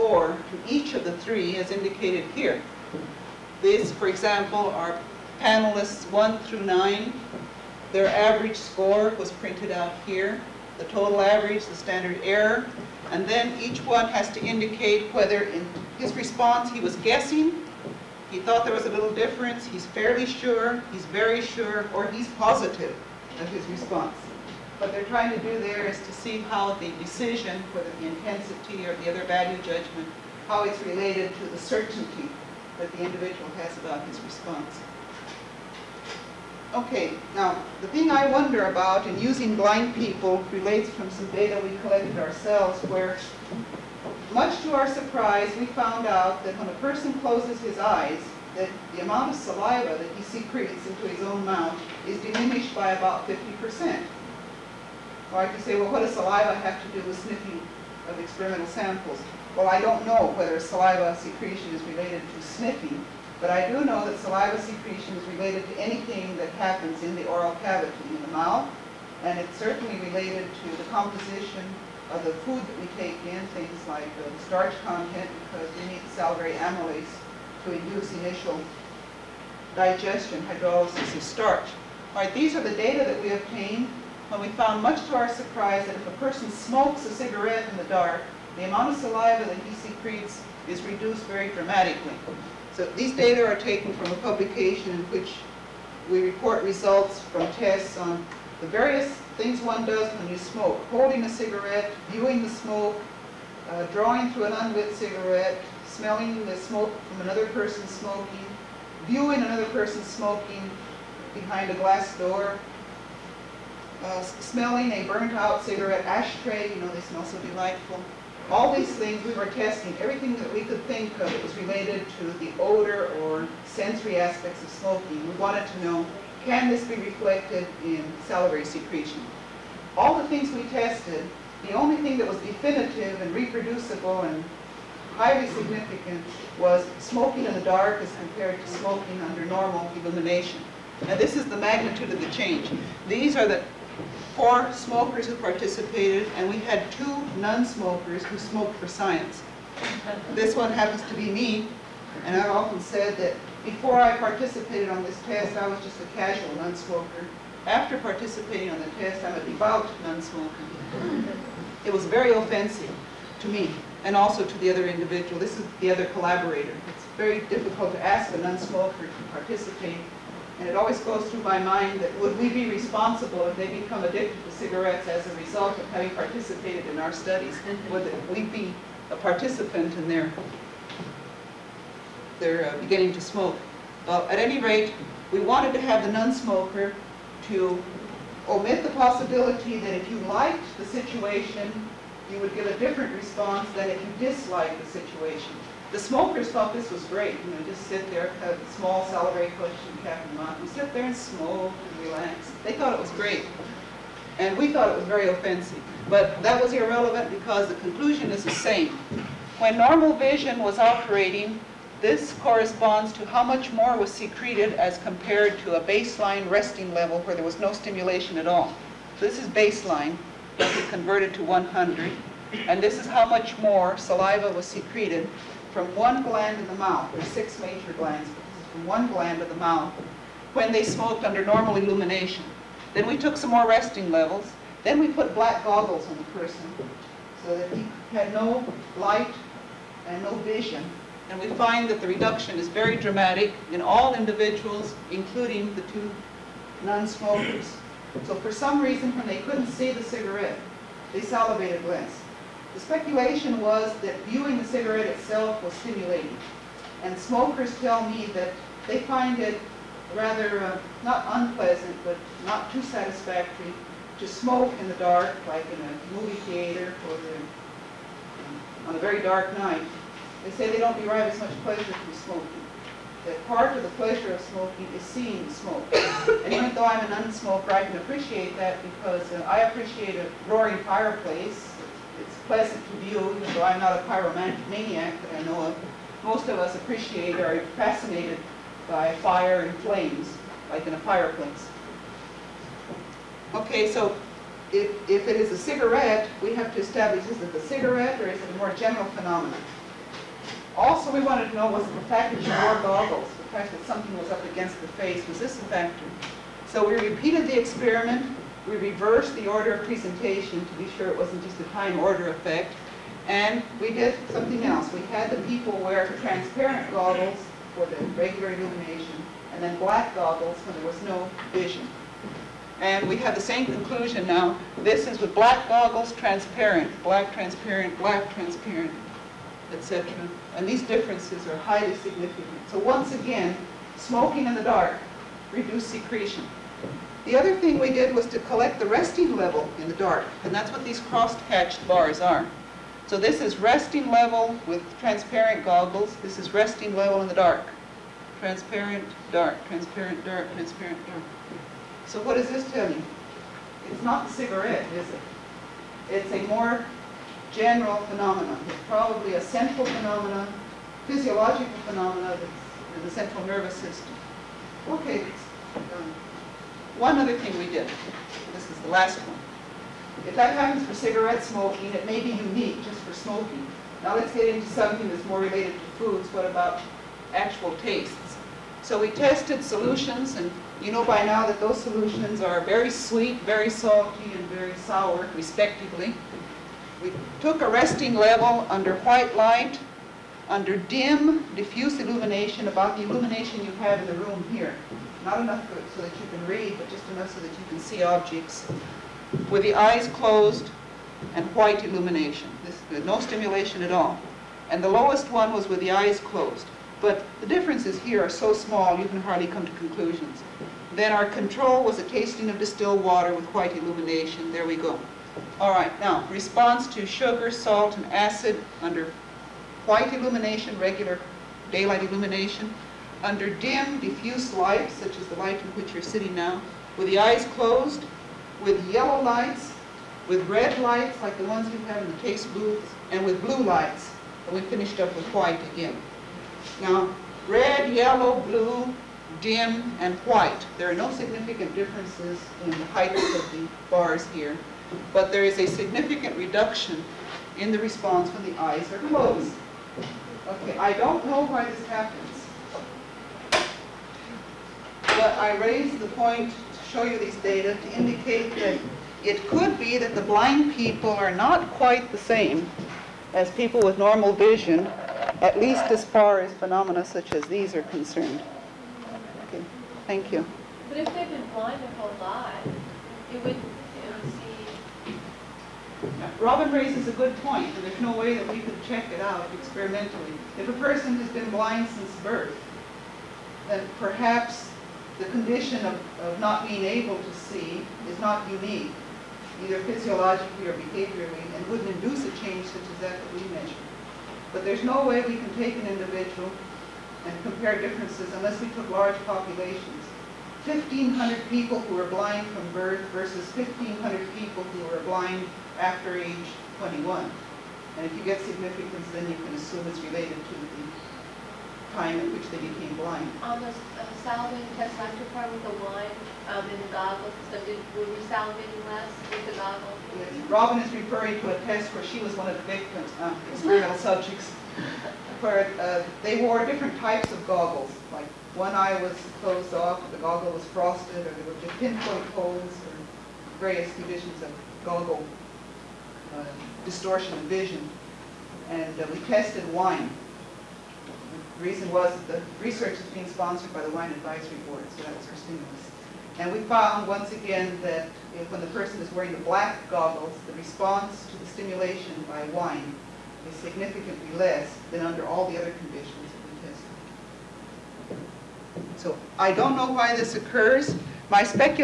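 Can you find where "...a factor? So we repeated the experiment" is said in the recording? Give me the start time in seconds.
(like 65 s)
305 s.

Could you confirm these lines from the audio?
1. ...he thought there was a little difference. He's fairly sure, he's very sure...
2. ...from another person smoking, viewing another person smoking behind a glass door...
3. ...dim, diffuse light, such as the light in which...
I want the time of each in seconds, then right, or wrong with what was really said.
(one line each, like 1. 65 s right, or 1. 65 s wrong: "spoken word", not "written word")
1. 18 s right
2. 107 s right
3. 423 s right.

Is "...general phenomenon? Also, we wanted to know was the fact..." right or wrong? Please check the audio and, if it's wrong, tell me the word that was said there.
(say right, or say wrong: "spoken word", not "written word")
right.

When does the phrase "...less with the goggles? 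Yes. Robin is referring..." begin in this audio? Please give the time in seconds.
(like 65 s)
518 s.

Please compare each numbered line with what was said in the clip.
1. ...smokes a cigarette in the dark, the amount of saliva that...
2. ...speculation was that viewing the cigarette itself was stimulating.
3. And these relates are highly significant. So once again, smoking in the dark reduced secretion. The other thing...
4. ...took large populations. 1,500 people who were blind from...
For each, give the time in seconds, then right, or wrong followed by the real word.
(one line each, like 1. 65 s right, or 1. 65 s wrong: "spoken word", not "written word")
1. 86 s right
2. 252 s right
3. 330 s wrong: "differences", not "relates"
4. 498 s right.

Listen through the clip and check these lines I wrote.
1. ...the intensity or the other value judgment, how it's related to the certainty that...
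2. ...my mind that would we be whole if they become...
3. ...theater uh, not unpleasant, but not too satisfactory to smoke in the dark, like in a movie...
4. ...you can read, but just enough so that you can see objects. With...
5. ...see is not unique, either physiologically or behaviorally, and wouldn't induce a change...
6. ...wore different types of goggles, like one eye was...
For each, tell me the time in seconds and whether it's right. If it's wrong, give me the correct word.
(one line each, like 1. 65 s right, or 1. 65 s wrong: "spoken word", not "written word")
1. 27 s right
2. 171 s wrong: "responsible", not "whole"
3. 260 s wrong: "rather", not "theater"
4. 396 s right
5. 487 s right
6. 526 s right.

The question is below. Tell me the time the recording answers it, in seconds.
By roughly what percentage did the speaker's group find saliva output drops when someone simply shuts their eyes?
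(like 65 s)
53 s.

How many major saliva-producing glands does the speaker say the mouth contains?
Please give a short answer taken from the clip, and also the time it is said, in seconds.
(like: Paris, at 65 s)
6, at 227 s.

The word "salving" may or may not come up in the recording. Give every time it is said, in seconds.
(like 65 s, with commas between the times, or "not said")
514 s, 518 s.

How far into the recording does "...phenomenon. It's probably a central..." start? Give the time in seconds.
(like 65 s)
358 s.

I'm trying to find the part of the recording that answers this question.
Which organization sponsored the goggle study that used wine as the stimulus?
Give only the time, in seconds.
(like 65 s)
543 s.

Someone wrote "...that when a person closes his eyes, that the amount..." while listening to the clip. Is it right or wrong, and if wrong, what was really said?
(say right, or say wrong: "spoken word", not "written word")
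right.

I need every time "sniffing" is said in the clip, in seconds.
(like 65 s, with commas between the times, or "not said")
57 s, 62 s.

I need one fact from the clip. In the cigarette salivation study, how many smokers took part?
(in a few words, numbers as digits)
4.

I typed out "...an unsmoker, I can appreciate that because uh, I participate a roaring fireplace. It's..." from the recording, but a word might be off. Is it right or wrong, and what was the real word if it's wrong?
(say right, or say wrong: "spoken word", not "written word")
wrong: "appreciate", not "participate".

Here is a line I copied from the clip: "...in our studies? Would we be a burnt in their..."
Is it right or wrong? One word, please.
wrong.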